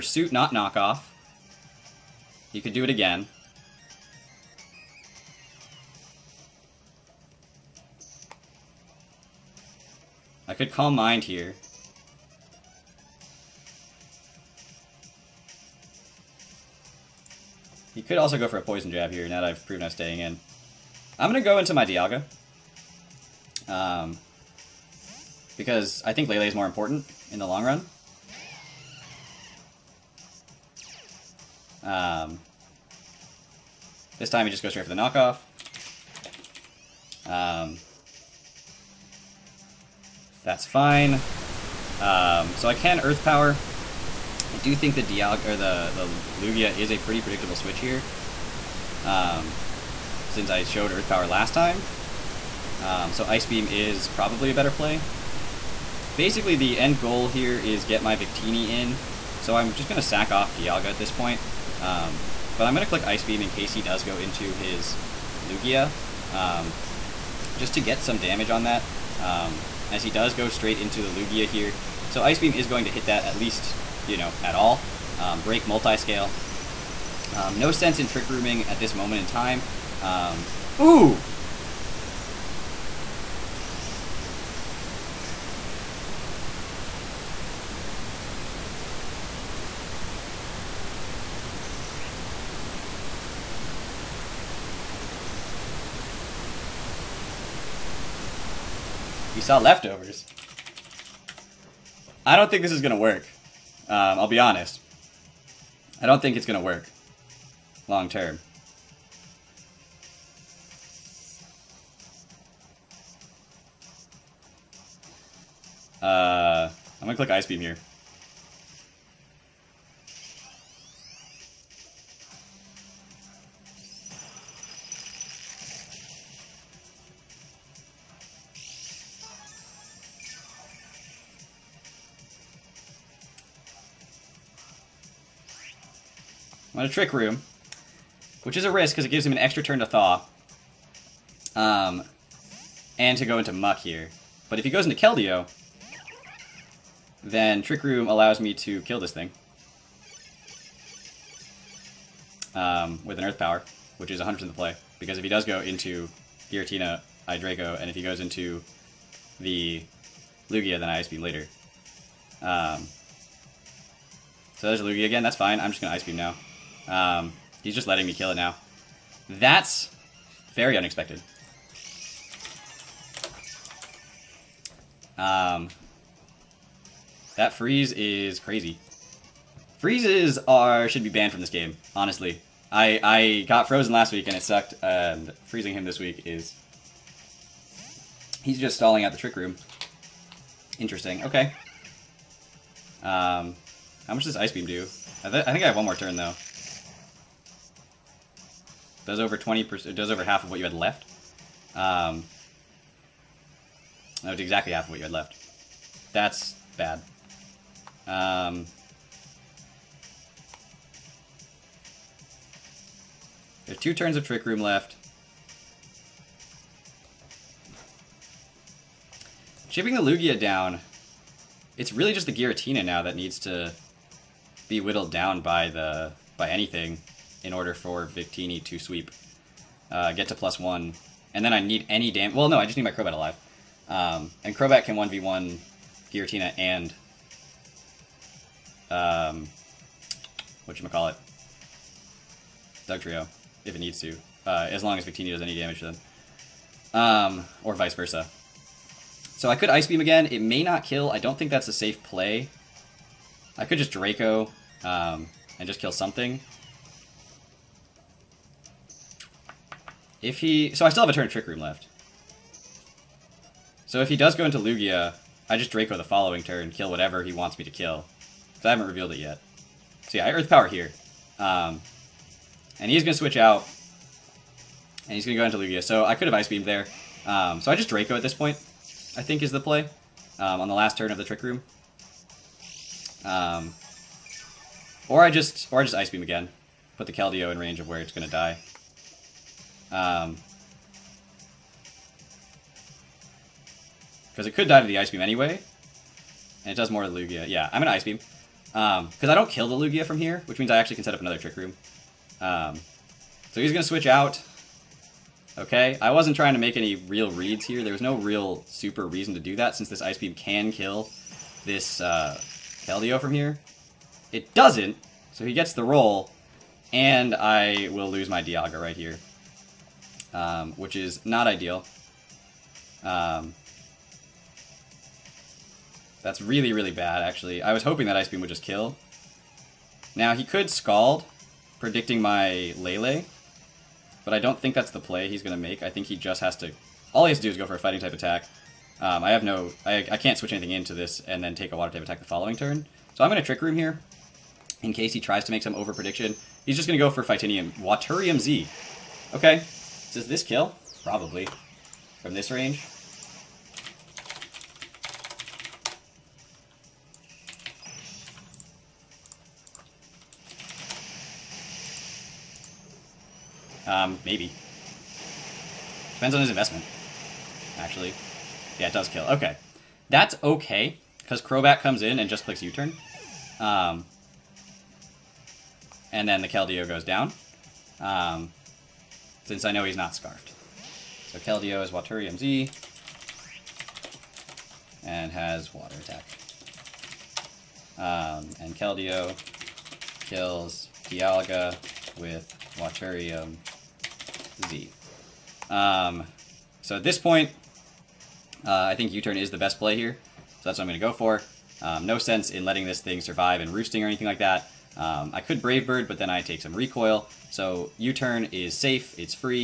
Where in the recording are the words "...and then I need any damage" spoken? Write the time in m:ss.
3:51.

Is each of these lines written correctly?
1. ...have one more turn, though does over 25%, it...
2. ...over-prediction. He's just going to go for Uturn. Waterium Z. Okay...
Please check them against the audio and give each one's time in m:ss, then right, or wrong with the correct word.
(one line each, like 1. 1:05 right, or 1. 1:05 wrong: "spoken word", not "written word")
1. 3:15 wrong: "20", not "25"
2. 5:45 wrong: "Fightinium", not "Uturn".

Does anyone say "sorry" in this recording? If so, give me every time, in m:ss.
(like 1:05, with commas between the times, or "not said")
not said.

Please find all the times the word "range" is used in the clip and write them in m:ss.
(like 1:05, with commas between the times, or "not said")
4:47, 5:52.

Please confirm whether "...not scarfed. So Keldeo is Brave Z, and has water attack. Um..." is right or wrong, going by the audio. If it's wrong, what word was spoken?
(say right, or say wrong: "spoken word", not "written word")
wrong: "Waterium", not "Brave".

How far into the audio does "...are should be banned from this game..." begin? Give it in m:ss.
3:00.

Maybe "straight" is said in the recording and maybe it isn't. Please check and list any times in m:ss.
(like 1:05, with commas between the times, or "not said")
0:34, 1:10.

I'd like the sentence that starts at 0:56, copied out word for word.
Basically, the end goal here is get my Victini in.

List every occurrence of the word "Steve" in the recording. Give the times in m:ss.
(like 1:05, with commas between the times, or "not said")
not said.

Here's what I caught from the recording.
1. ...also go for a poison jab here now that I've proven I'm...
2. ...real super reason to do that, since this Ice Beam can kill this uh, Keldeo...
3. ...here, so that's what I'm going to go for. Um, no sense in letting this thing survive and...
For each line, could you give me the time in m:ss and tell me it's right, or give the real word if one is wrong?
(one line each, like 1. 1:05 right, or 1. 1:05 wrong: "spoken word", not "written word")
1. 0:18 right
2. 5:08 right
3. 6:39 right.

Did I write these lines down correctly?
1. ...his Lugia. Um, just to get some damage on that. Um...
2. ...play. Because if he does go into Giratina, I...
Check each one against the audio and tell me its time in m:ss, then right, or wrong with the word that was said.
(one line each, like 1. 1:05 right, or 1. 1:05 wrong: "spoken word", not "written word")
1. 1:04 right
2. 2:34 right.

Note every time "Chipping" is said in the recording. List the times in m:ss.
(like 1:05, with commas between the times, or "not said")
3:39.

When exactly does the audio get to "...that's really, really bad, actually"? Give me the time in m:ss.
5:26.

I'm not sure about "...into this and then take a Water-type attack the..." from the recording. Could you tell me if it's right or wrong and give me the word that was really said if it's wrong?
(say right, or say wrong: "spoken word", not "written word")
right.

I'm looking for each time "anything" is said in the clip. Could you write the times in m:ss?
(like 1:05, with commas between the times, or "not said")
3:46, 5:40, 6:44.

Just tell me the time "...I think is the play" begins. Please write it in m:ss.
4:39.